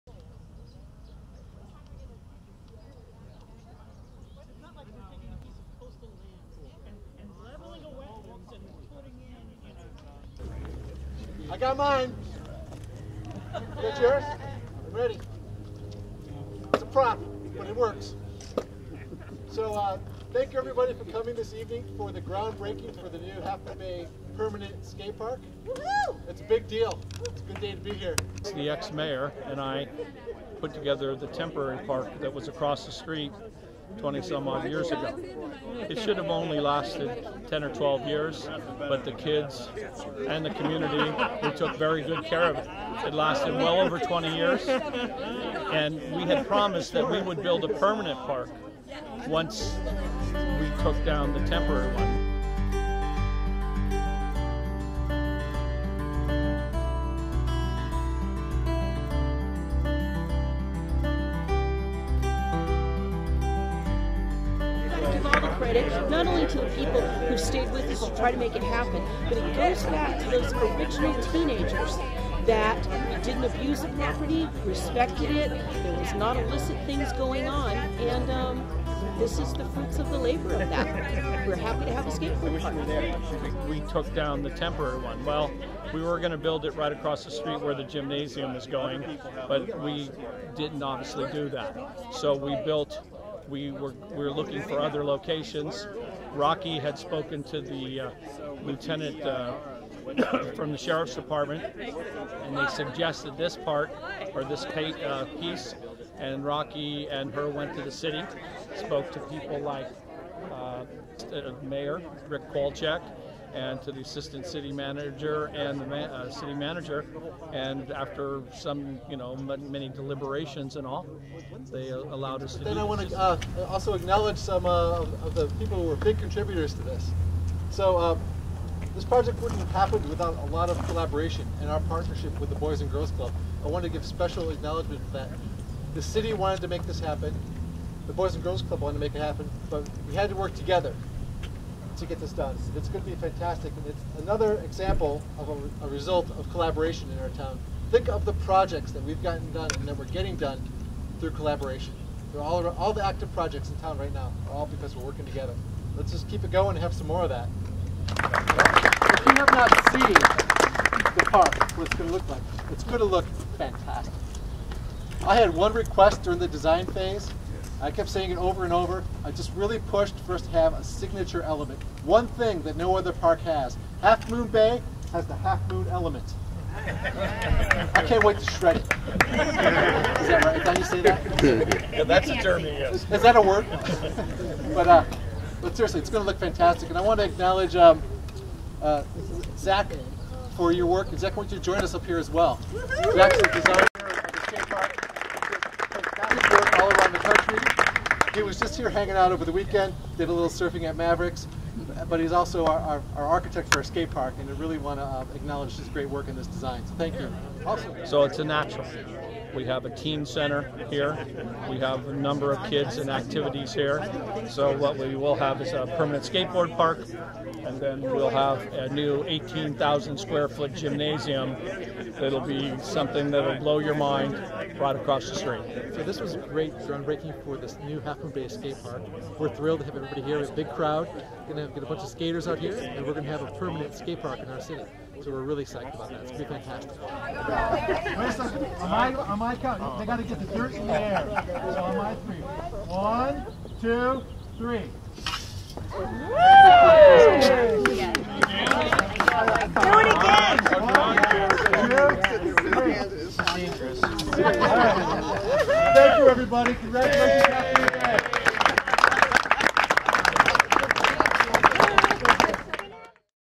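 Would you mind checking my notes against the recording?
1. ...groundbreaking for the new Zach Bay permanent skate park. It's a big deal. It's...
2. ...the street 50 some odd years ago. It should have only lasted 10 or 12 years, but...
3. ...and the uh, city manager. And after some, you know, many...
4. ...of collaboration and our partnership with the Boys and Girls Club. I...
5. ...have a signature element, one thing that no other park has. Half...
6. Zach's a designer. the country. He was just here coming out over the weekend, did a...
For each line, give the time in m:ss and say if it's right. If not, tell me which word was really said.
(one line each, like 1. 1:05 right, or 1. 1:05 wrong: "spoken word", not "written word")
1. 0:22 wrong: "Half", not "Zach"
2. 0:32 wrong: "20", not "50"
3. 1:55 right
4. 2:10 right
5. 2:50 right
6. 3:13 wrong: "hanging", not "coming".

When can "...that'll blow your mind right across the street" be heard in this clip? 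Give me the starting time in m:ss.
3:43.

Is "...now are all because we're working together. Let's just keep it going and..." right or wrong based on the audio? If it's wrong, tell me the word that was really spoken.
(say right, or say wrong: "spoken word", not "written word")
right.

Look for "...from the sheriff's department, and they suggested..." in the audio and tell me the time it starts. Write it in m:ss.
1:40.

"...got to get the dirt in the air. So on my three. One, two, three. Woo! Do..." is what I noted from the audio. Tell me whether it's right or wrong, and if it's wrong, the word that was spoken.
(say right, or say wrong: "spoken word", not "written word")
right.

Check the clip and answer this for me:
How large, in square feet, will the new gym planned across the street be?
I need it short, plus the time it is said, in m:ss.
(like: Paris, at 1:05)
18,000 square feet, at 3:39.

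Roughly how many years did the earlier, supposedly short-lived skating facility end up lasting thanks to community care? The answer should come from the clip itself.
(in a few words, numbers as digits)
over 20 years.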